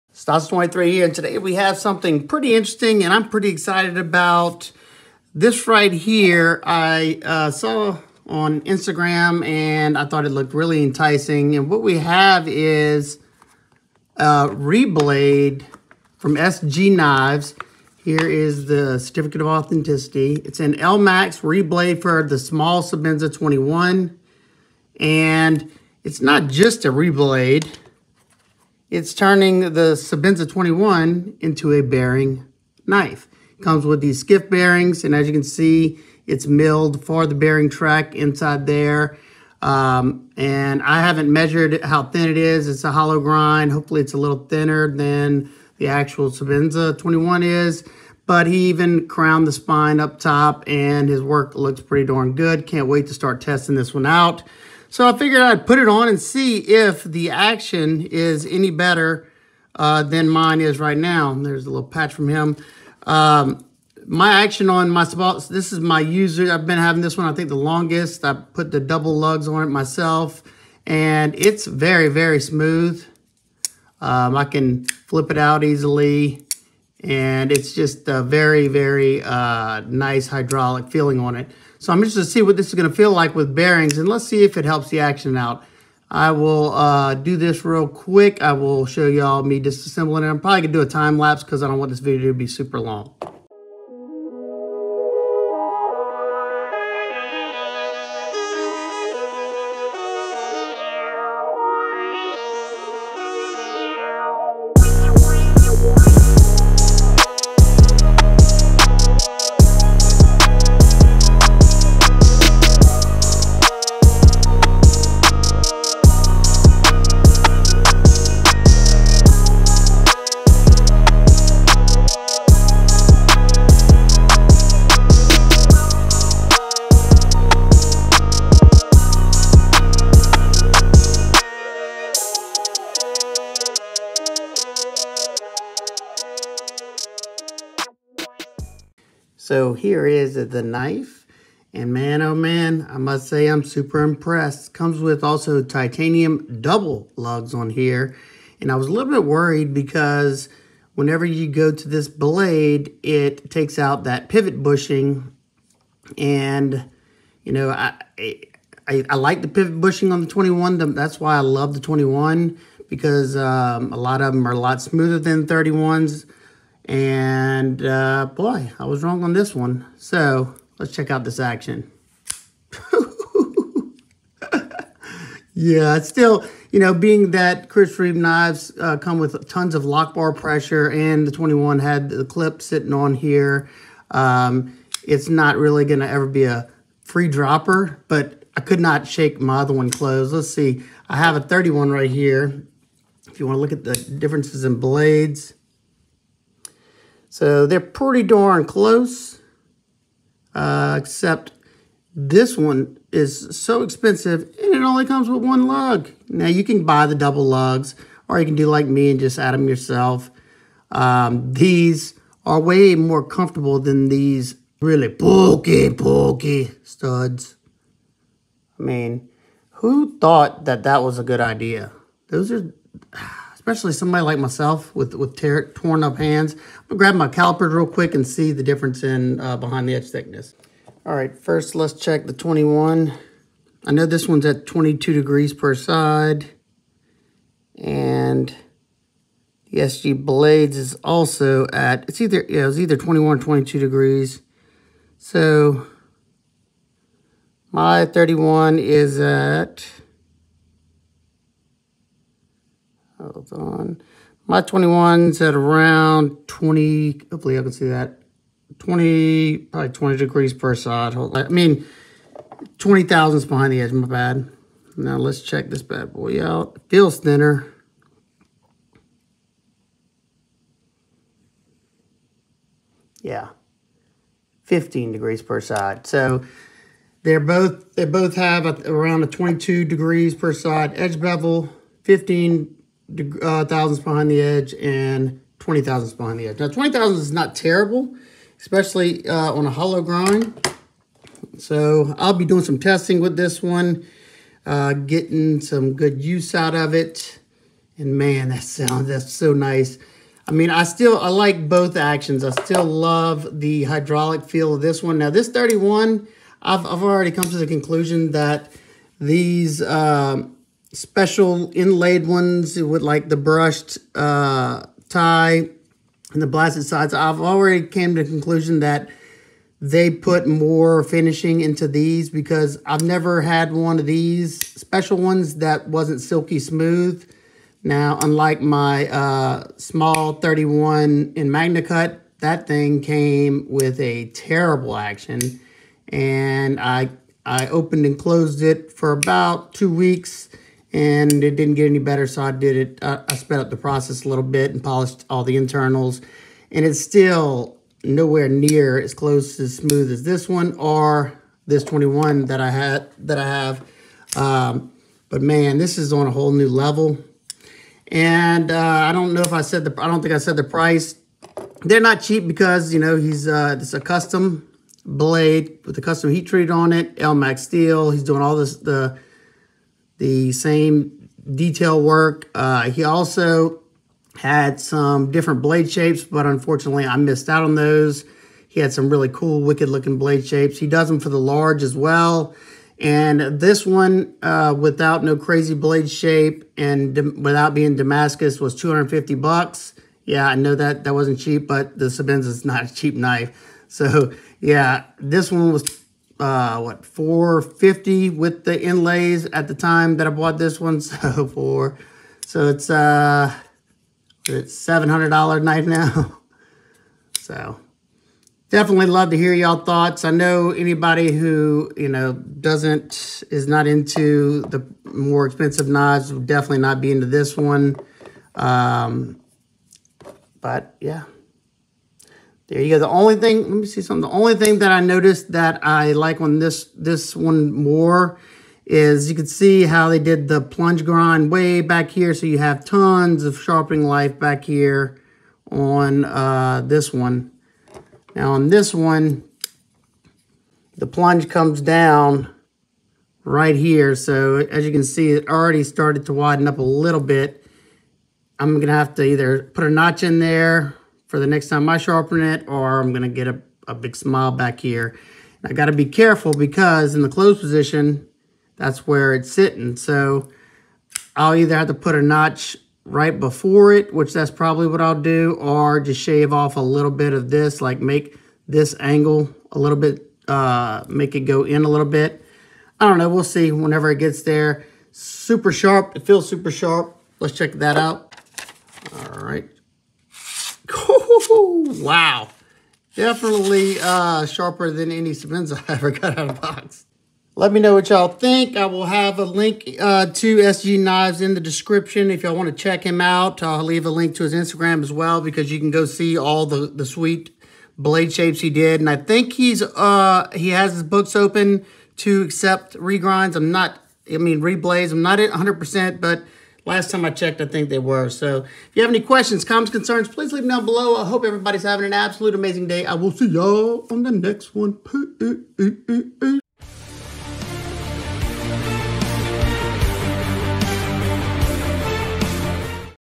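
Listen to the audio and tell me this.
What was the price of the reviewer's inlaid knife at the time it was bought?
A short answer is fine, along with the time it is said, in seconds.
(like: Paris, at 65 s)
450, at 397 s.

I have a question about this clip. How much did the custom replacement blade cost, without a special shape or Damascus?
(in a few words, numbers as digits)
$250.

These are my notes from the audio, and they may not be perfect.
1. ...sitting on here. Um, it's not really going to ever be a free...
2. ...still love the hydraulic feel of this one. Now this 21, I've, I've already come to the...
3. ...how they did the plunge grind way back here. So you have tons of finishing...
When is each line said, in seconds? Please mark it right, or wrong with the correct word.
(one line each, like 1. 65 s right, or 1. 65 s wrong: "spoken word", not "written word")
1. 182 s right
2. 302 s wrong: "31", not "21"
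3. 429 s wrong: "sharpening", not "finishing".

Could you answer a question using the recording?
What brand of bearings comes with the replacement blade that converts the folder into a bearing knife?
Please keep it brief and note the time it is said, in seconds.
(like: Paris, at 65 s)
skiff, at 34 s.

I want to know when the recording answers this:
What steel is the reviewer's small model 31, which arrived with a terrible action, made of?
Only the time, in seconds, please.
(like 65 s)
331 s.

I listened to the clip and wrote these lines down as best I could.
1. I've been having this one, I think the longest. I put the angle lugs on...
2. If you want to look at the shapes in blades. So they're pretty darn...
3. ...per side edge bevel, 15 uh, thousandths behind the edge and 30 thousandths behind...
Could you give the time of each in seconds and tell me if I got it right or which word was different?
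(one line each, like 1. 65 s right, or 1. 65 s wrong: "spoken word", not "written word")
1. 66 s wrong: "double", not "angle"
2. 193 s wrong: "differences", not "shapes"
3. 280 s wrong: "20", not "30".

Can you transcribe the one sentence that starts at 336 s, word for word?
And I, I opened and closed it for about two weeks and it didn't get any better.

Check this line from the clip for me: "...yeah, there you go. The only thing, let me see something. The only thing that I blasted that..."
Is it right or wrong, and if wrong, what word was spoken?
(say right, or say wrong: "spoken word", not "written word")
wrong: "noticed", not "blasted".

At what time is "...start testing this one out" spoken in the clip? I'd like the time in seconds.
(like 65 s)
53 s.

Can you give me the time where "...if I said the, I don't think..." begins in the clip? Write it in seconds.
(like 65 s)
359 s.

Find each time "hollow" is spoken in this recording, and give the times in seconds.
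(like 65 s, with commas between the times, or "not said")
42 s, 289 s.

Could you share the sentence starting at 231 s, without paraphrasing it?
All right, first let's check the 21.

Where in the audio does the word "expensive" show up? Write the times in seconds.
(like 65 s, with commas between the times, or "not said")
203 s, 415 s.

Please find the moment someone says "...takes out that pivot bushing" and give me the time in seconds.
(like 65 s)
153 s.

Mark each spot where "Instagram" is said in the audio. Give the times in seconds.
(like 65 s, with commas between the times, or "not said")
8 s, 494 s.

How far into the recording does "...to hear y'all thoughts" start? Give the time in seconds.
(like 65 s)
409 s.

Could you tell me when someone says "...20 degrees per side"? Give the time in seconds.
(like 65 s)
259 s.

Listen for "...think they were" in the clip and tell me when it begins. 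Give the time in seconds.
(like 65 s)
507 s.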